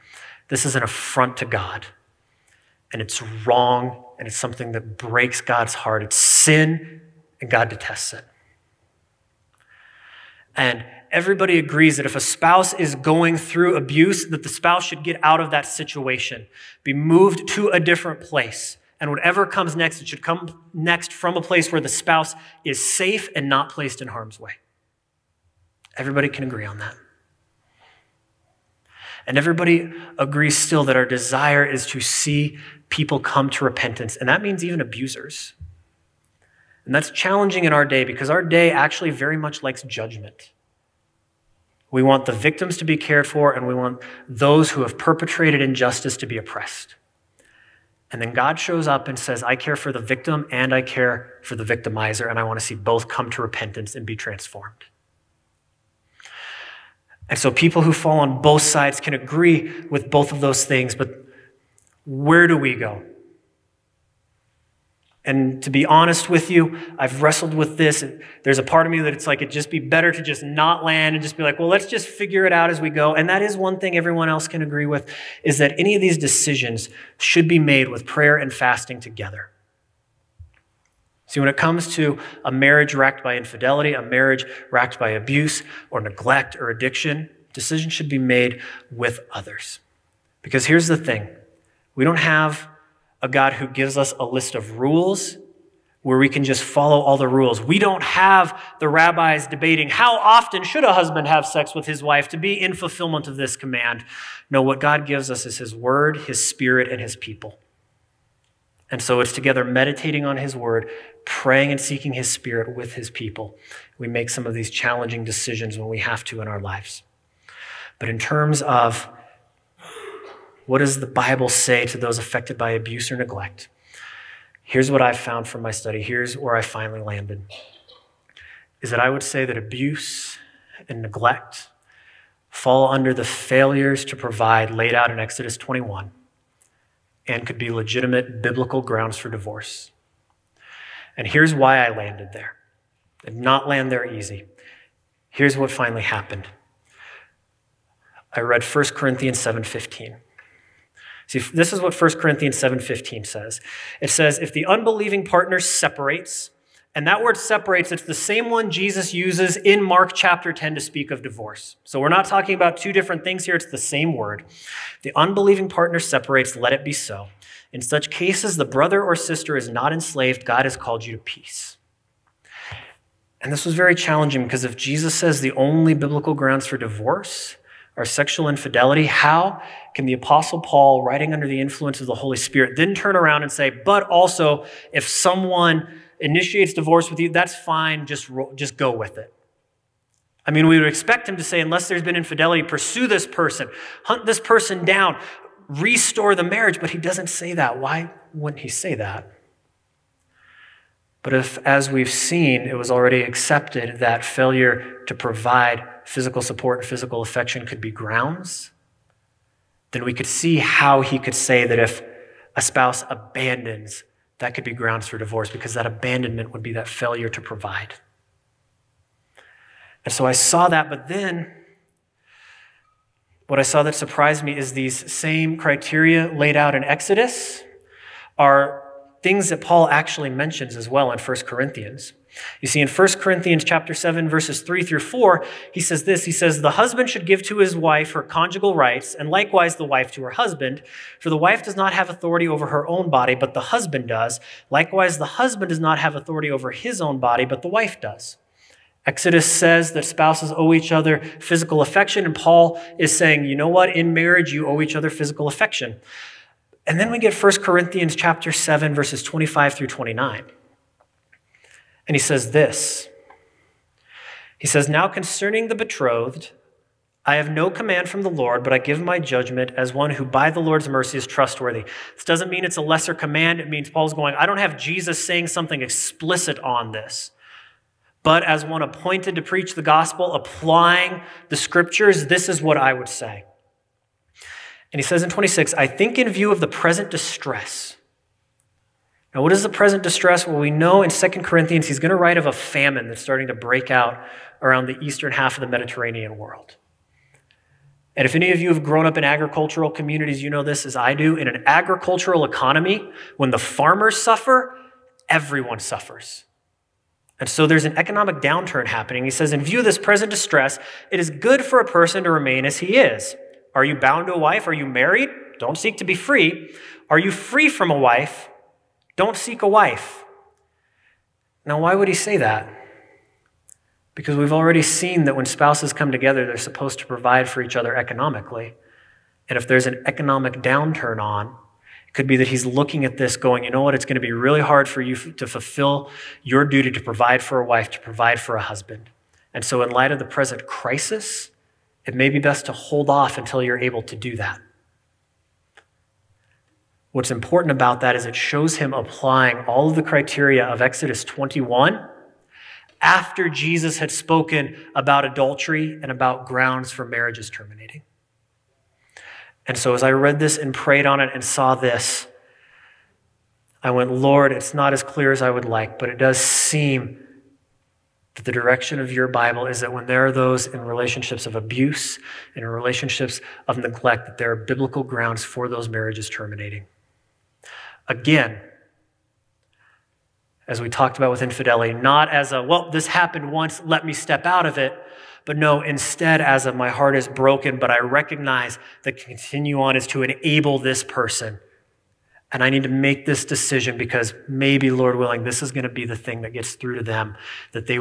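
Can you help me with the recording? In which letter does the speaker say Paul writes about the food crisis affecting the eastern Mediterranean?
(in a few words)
2 Corinthians.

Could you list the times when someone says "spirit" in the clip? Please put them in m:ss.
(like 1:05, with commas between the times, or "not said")
1:46, 1:52, 3:02.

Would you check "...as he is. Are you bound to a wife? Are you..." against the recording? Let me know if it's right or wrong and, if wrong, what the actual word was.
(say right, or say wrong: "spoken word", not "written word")
right.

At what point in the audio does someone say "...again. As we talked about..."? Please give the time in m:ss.
6:18.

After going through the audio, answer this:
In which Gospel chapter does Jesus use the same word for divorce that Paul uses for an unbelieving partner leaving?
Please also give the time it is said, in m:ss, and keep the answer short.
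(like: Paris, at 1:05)
Mark chapter 10, at 2:39.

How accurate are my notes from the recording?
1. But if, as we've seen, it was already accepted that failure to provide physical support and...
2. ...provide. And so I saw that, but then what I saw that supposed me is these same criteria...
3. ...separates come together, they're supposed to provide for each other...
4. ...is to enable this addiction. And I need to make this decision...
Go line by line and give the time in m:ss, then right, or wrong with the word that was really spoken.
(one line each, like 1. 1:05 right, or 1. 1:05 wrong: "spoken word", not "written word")
1. 3:21 right
2. 3:37 wrong: "surprised", not "supposed"
3. 5:25 wrong: "spouses", not "separates"
4. 6:29 wrong: "person", not "addiction".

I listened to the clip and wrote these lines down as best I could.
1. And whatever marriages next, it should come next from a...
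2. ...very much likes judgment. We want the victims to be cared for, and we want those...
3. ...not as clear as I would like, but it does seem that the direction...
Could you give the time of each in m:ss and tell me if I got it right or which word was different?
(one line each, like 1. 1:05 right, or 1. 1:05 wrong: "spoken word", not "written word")
1. 0:18 wrong: "comes", not "marriages"
2. 0:39 right
3. 6:04 right.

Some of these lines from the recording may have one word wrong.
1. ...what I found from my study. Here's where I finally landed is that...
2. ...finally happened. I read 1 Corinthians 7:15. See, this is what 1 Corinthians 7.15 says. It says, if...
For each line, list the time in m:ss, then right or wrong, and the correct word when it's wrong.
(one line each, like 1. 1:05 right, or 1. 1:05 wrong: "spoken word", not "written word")
1. 2:04 right
2. 2:25 right.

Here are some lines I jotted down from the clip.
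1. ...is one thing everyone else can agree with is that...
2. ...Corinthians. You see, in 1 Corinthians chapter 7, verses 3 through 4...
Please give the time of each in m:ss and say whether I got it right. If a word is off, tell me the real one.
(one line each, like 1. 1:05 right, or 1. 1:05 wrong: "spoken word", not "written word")
1. 1:13 right
2. 3:51 right.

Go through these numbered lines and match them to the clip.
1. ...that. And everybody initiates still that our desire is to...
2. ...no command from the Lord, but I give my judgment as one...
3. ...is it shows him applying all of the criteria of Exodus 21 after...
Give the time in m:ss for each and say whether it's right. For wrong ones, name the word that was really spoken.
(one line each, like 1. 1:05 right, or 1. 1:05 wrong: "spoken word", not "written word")
1. 0:26 wrong: "agrees", not "initiates"
2. 4:27 right
3. 5:48 right.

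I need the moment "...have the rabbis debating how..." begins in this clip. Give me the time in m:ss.
1:38.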